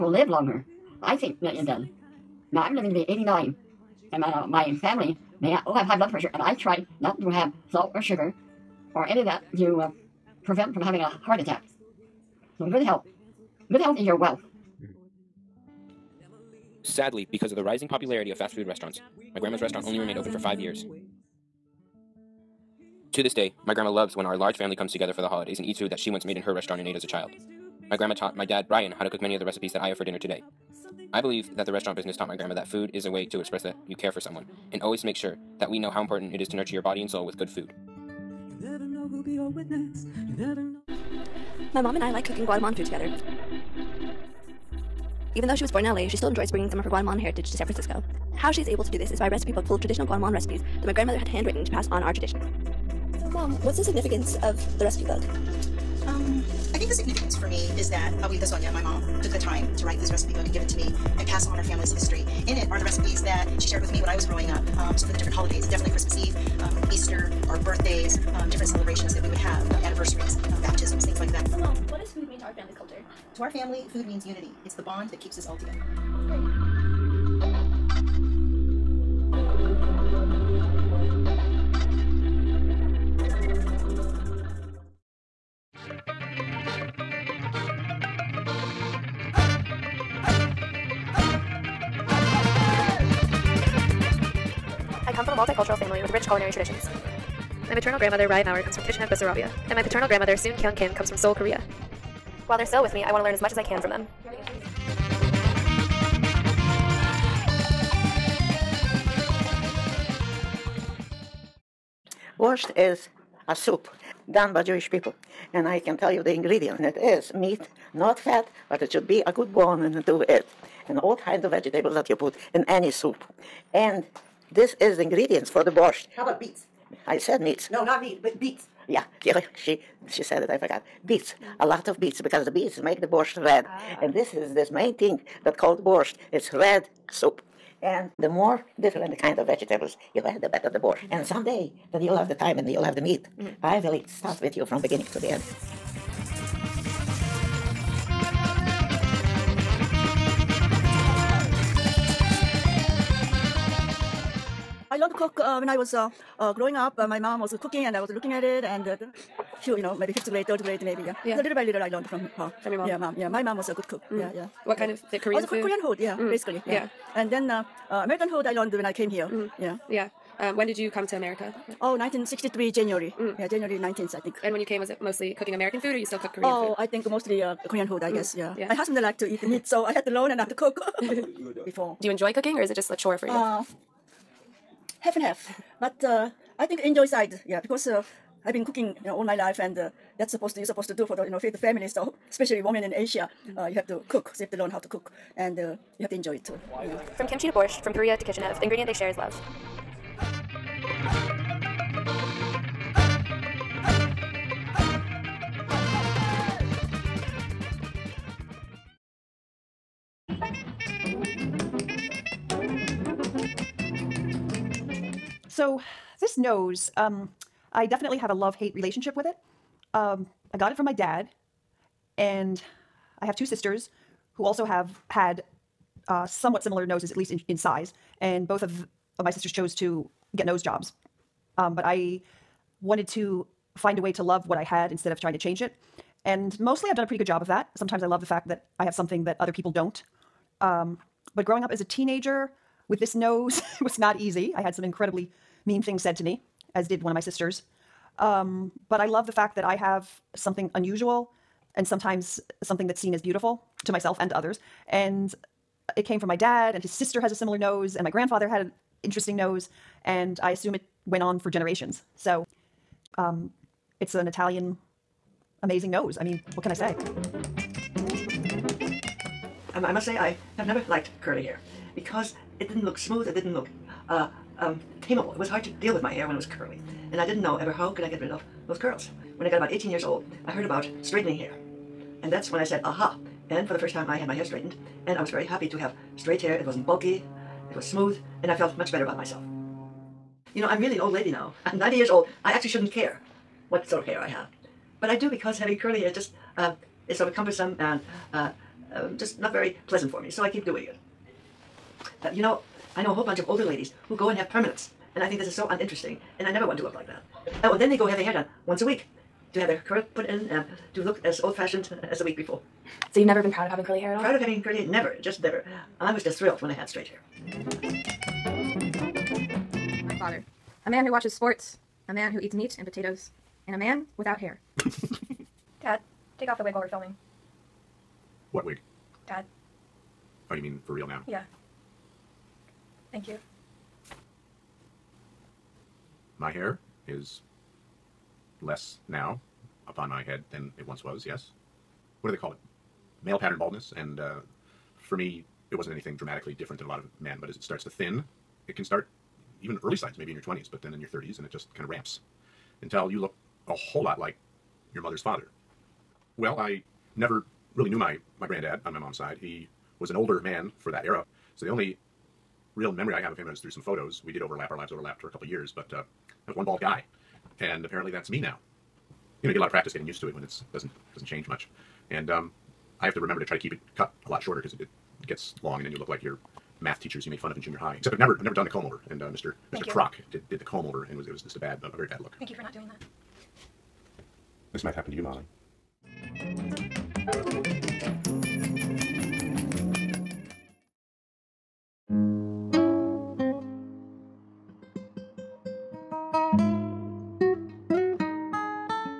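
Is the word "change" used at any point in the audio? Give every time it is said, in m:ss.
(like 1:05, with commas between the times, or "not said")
3:55, 6:11.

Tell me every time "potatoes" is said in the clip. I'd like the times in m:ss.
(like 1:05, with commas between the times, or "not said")
5:22.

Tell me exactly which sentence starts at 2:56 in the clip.
I think mostly uh, Korean food.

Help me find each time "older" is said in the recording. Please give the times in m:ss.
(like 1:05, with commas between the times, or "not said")
5:03, 6:00.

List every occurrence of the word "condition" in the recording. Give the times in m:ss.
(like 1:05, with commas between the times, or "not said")
not said.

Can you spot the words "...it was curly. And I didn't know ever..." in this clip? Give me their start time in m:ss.
4:36.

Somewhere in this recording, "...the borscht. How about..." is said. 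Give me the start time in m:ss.
2:05.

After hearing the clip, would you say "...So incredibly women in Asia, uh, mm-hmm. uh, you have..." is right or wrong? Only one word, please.
wrong.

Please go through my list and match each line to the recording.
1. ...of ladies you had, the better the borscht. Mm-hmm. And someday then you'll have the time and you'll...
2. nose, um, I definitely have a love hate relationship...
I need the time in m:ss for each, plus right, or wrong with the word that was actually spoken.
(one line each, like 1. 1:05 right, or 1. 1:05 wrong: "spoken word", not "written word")
1. 2:19 wrong: "vegetables", not "ladies"
2. 3:36 right.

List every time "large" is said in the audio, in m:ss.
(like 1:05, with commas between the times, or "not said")
0:24.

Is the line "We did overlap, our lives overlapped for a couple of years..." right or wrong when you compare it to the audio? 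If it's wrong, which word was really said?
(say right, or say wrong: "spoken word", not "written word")
right.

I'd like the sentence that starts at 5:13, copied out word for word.
So you've never been proud of having curly hair at all?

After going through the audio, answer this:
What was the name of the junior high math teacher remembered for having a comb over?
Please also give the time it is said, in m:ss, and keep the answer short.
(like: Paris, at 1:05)
Mr. Croc, at 6:19.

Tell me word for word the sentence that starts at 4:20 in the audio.
And I assume it went on for generations.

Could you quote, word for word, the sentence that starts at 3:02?
Do you enjoy cooking, or is it just a chore for you?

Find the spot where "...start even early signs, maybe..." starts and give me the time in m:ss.
5:48.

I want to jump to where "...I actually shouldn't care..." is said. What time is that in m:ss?
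4:52.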